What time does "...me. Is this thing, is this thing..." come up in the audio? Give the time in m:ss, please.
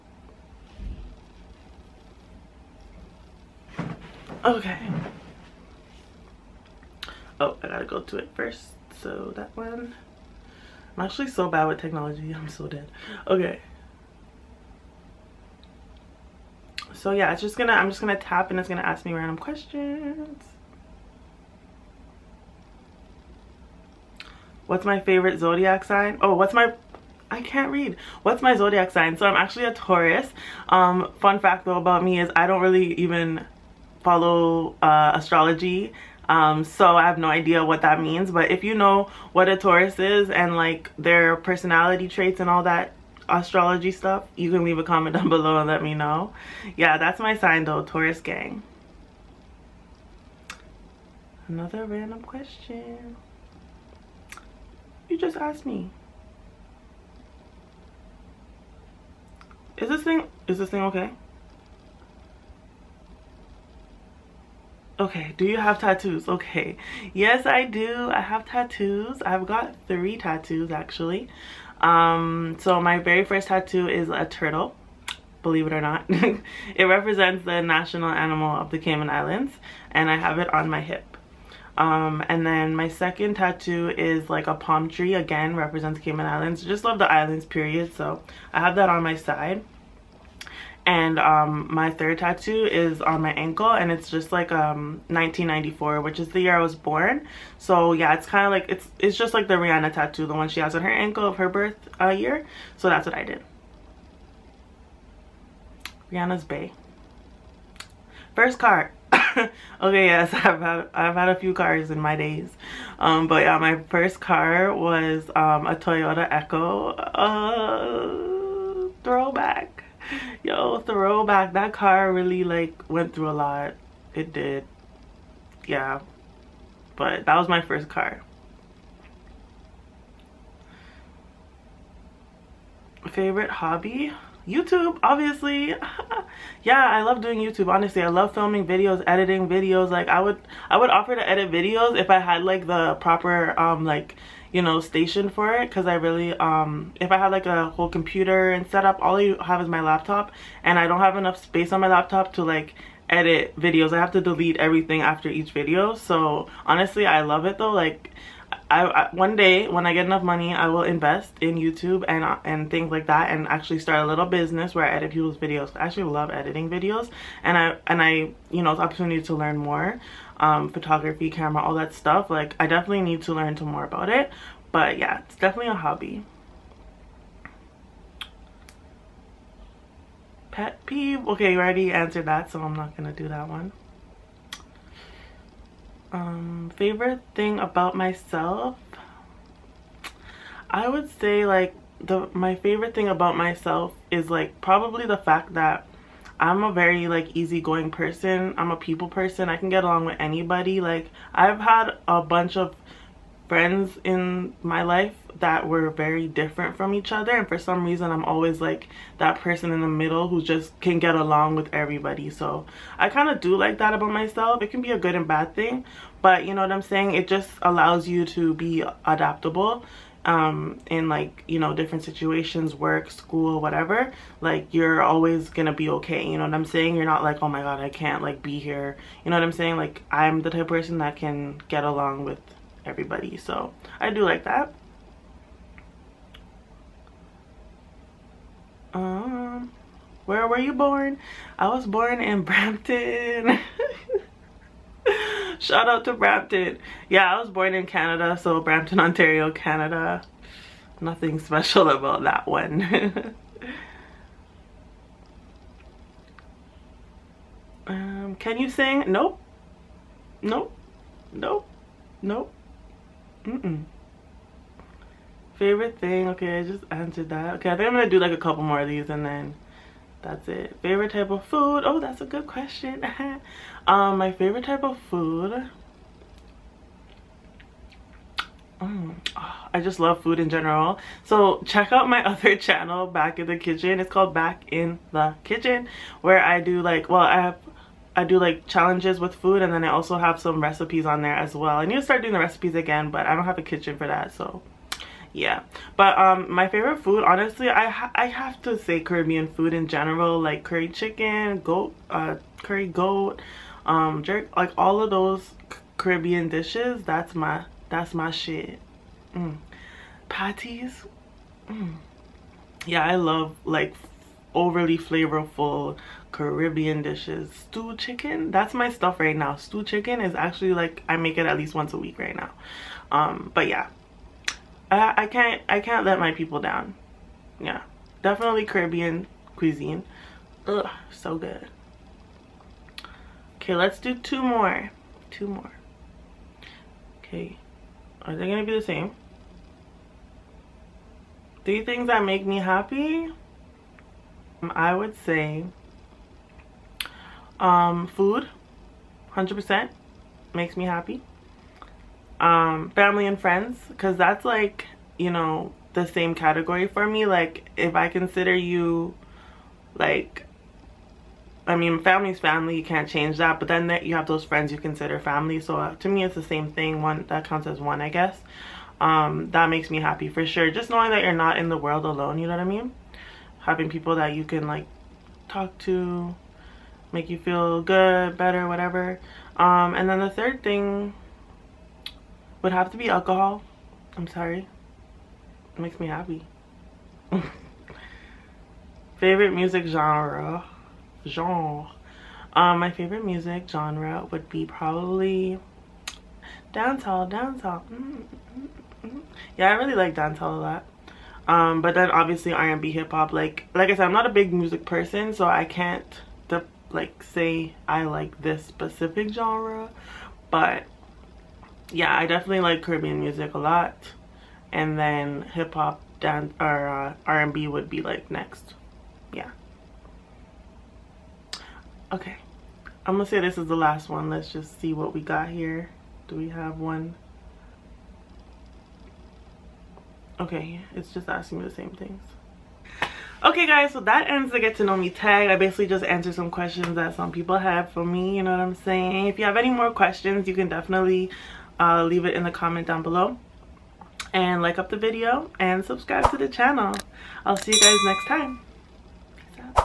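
0:55.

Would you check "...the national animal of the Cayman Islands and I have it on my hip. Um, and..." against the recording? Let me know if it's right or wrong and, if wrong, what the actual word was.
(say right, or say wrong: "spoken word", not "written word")
right.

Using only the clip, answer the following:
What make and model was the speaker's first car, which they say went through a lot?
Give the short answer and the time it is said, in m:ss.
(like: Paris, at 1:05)
Toyota Echo, at 1:55.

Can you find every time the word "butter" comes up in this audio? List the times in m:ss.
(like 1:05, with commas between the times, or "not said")
not said.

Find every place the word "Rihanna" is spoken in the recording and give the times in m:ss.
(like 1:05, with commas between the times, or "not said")
1:39, 1:46.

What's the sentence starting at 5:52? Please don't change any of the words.
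Um, family and friends, because that's like, you know, the same category for me.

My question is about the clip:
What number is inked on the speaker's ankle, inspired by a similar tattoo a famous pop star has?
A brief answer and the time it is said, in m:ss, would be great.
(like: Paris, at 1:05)
1994, at 1:35.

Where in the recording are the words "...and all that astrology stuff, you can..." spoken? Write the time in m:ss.
0:42.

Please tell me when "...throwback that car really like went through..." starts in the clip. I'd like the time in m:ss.
2:00.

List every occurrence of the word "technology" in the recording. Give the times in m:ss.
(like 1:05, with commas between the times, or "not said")
0:11.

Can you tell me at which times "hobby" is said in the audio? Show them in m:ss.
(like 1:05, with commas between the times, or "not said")
2:13, 2:55.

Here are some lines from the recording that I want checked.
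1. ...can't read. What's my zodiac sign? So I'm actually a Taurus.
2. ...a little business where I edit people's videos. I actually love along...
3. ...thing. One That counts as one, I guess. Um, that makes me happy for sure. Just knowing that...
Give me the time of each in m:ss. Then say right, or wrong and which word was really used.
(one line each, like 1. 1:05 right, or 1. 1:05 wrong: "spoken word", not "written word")
1. 0:27 right
2. 2:44 wrong: "editing", not "along"
3. 6:06 right.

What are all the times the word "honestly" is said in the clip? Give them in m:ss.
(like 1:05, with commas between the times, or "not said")
2:17, 2:36, 4:57.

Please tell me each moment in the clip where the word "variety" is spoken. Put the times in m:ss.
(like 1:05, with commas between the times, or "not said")
not said.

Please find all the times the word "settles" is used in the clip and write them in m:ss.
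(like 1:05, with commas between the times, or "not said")
not said.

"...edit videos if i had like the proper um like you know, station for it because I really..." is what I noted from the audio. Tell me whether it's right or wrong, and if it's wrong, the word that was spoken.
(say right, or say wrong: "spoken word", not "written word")
right.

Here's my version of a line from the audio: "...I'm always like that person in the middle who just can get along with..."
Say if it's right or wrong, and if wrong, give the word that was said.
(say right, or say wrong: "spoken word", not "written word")
right.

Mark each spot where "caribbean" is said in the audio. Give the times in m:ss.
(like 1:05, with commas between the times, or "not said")
4:58, 5:05, 5:16, 5:28, 6:52.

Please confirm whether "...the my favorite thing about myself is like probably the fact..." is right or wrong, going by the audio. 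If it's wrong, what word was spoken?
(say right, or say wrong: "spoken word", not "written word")
right.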